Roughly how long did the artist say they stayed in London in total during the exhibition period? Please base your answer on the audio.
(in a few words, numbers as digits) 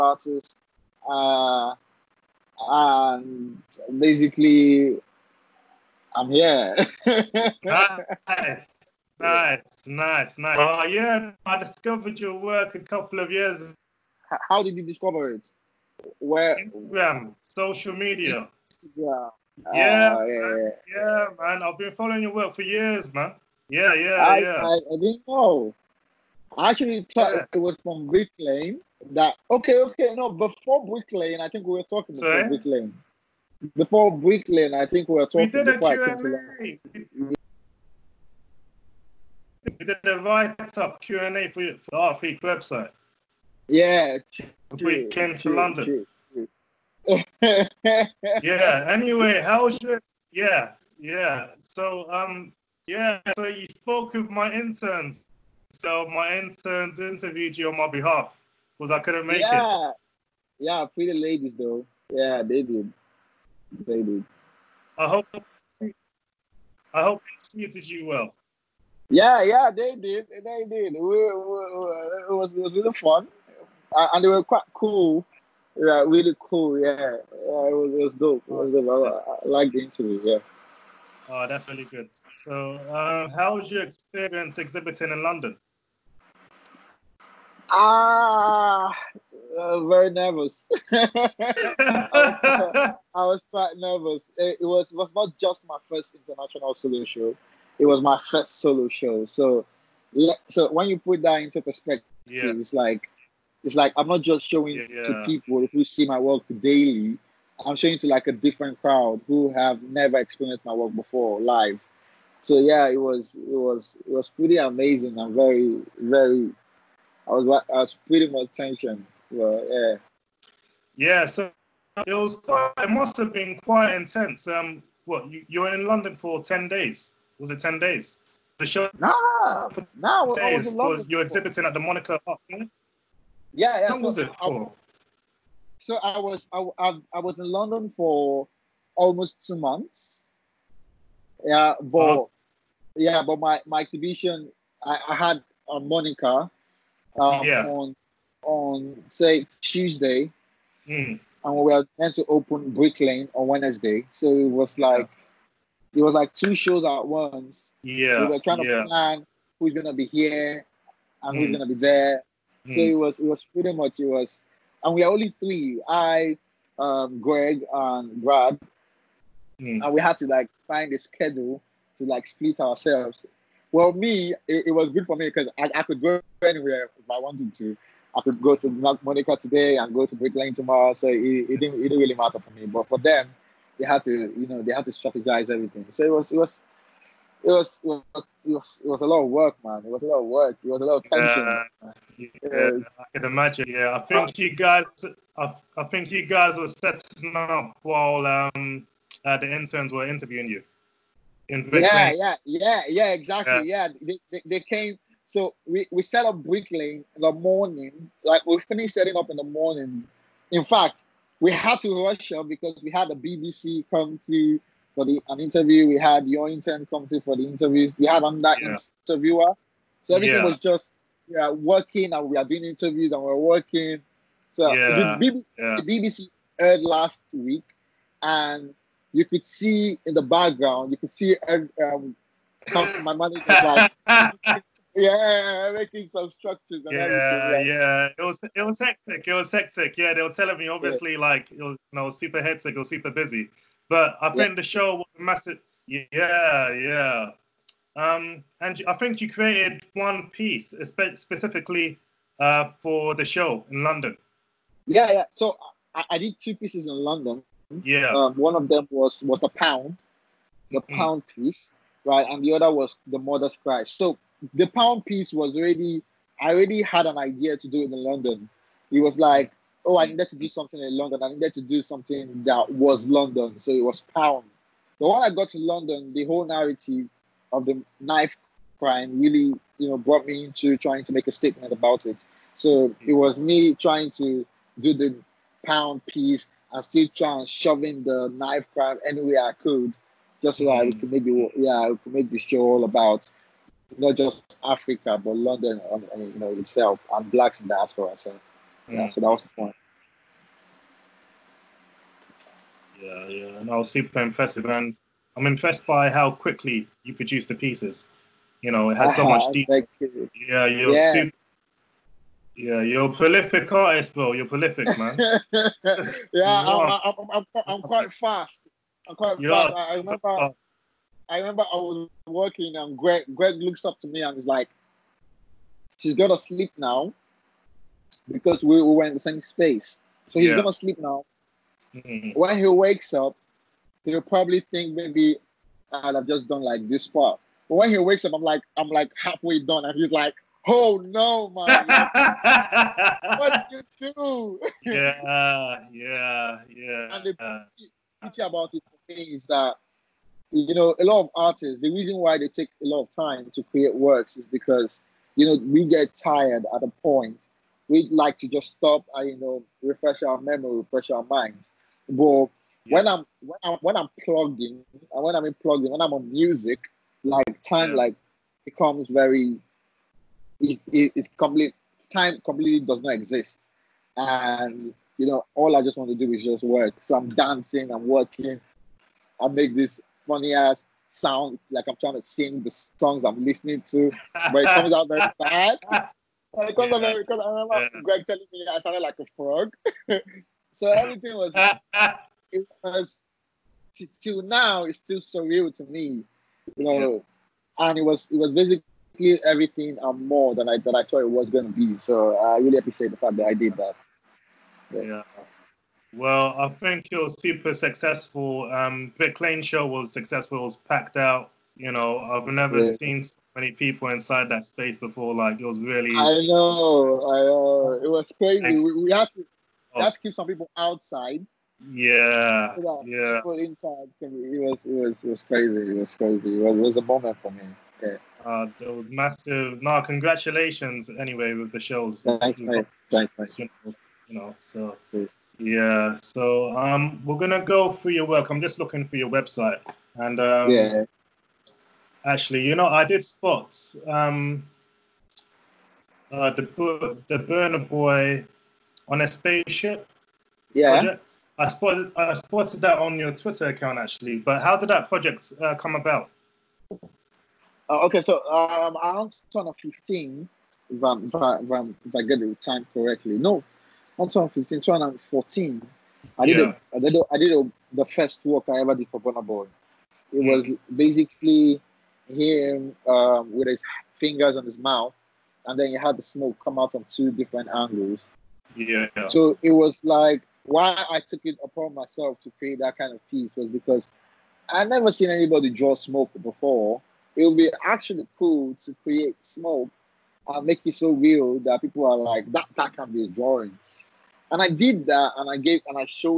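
Almost two months.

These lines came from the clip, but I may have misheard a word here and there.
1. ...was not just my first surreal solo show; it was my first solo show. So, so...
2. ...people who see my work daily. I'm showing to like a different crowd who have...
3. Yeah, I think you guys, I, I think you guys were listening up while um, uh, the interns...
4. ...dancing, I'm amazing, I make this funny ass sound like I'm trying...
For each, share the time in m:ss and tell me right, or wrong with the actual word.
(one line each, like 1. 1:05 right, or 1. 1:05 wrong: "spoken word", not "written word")
1. 1:34 wrong: "international", not "surreal"
2. 1:45 right
3. 3:13 wrong: "setting", not "listening"
4. 6:17 wrong: "working", not "amazing".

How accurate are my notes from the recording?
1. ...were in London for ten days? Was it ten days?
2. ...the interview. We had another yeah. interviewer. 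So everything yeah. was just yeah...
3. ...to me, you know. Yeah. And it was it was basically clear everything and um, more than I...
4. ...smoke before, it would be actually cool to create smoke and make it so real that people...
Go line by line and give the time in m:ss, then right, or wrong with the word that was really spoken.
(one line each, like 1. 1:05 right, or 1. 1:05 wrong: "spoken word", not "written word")
1. 2:05 right
2. 3:37 right
3. 6:35 right
4. 8:05 right.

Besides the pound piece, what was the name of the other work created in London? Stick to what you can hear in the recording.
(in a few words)
The mother's cry.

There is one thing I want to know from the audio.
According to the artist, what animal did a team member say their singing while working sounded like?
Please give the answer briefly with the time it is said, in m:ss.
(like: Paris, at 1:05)
A frog, at 6:29.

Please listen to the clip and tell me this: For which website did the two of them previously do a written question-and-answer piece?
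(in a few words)
Art Freak.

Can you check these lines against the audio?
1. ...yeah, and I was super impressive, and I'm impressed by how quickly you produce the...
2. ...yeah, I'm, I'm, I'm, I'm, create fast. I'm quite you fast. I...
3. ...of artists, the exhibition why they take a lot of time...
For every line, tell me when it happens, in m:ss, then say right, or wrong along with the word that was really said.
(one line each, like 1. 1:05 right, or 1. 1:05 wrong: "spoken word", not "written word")
1. 5:03 right
2. 5:16 wrong: "quite", not "create"
3. 5:51 wrong: "reason", not "exhibition".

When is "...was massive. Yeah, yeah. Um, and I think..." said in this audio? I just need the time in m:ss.
4:04.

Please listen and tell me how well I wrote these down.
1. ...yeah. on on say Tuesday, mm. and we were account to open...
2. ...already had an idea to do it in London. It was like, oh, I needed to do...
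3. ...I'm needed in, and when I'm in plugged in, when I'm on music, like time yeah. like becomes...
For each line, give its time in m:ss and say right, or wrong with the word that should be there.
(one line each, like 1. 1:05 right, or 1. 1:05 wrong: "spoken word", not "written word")
1. 2:27 wrong: "meant", not "account"
2. 4:26 right
3. 6:03 wrong: "plugged", not "needed".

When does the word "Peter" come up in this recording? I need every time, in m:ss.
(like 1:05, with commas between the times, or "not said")
not said.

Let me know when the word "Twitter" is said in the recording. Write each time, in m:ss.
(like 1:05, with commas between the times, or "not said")
7:33.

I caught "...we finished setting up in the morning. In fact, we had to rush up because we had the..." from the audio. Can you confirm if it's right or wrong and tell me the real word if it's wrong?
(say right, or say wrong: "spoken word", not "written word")
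right.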